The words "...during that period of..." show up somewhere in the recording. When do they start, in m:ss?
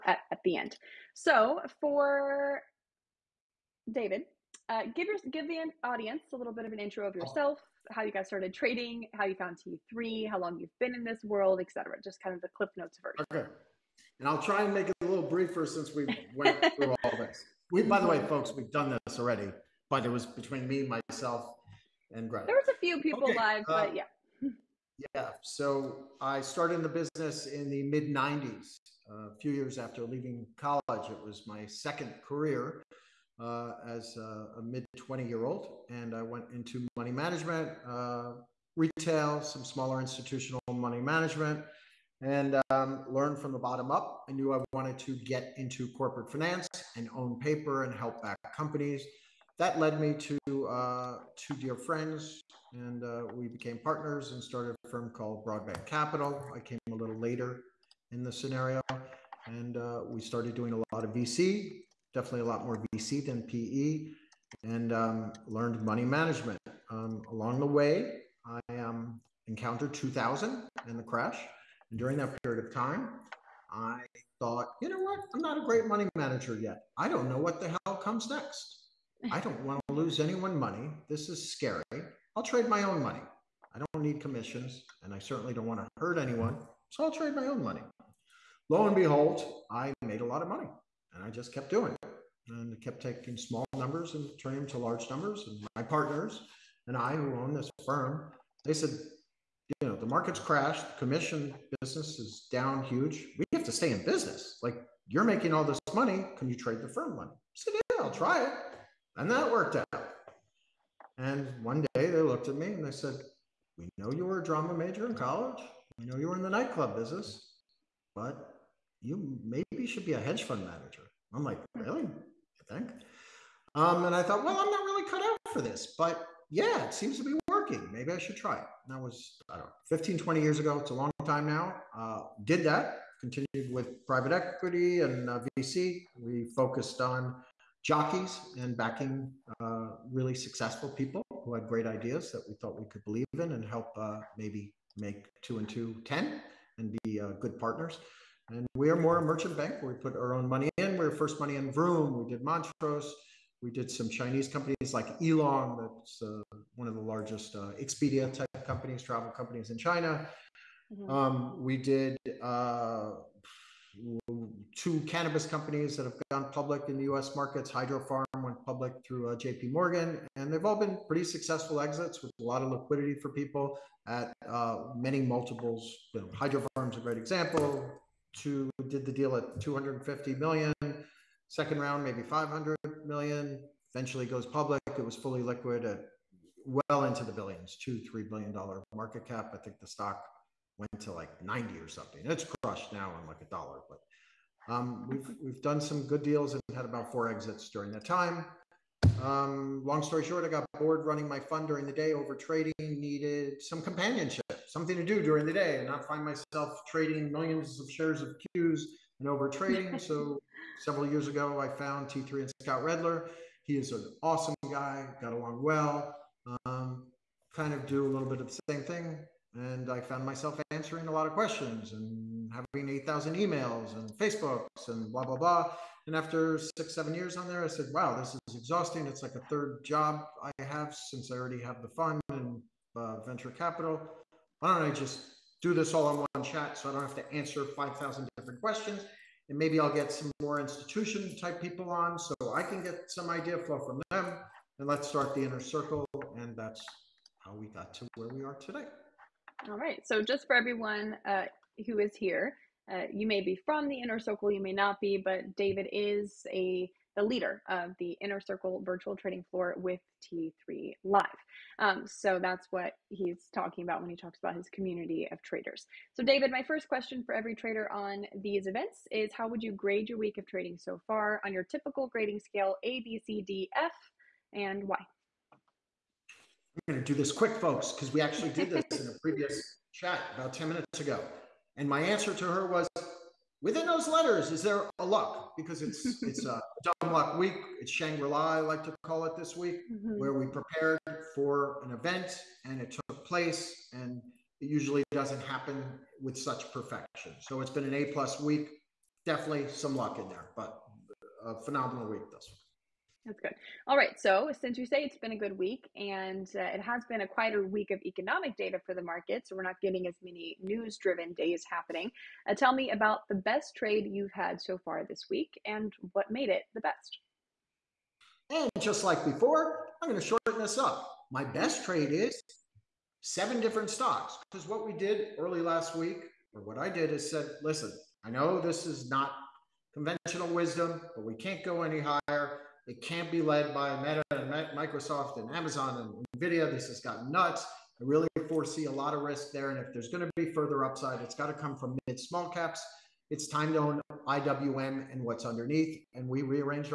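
1:11.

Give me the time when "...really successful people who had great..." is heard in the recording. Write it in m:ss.
2:20.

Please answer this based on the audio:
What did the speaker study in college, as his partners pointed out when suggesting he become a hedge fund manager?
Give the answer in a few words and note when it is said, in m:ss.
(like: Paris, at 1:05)
Drama, at 1:54.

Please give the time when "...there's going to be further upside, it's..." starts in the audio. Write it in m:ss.
5:39.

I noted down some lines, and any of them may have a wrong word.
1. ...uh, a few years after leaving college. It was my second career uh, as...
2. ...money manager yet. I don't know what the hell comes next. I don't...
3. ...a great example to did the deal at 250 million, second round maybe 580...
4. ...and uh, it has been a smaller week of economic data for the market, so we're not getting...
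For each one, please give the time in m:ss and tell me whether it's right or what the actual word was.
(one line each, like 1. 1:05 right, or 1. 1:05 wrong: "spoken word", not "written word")
1. 0:29 right
2. 1:15 right
3. 2:56 wrong: "500", not "580"
4. 5:05 wrong: "quieter", not "smaller".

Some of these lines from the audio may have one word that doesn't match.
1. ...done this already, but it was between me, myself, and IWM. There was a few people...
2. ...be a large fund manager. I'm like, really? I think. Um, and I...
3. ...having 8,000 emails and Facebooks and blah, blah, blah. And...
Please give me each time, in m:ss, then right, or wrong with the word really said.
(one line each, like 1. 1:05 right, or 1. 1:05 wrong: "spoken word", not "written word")
1. 0:18 wrong: "Greg", not "IWM"
2. 2:00 wrong: "hedge", not "large"
3. 3:42 right.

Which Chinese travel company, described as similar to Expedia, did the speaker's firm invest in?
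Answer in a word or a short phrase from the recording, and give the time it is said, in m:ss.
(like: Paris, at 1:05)
eLong, at 2:35.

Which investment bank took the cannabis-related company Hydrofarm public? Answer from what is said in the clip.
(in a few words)
J.P. Morgan.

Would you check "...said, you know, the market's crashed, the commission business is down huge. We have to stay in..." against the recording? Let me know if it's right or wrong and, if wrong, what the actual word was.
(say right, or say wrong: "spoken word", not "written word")
right.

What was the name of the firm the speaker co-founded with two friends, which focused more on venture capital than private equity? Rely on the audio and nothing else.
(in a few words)
Broadband Capital.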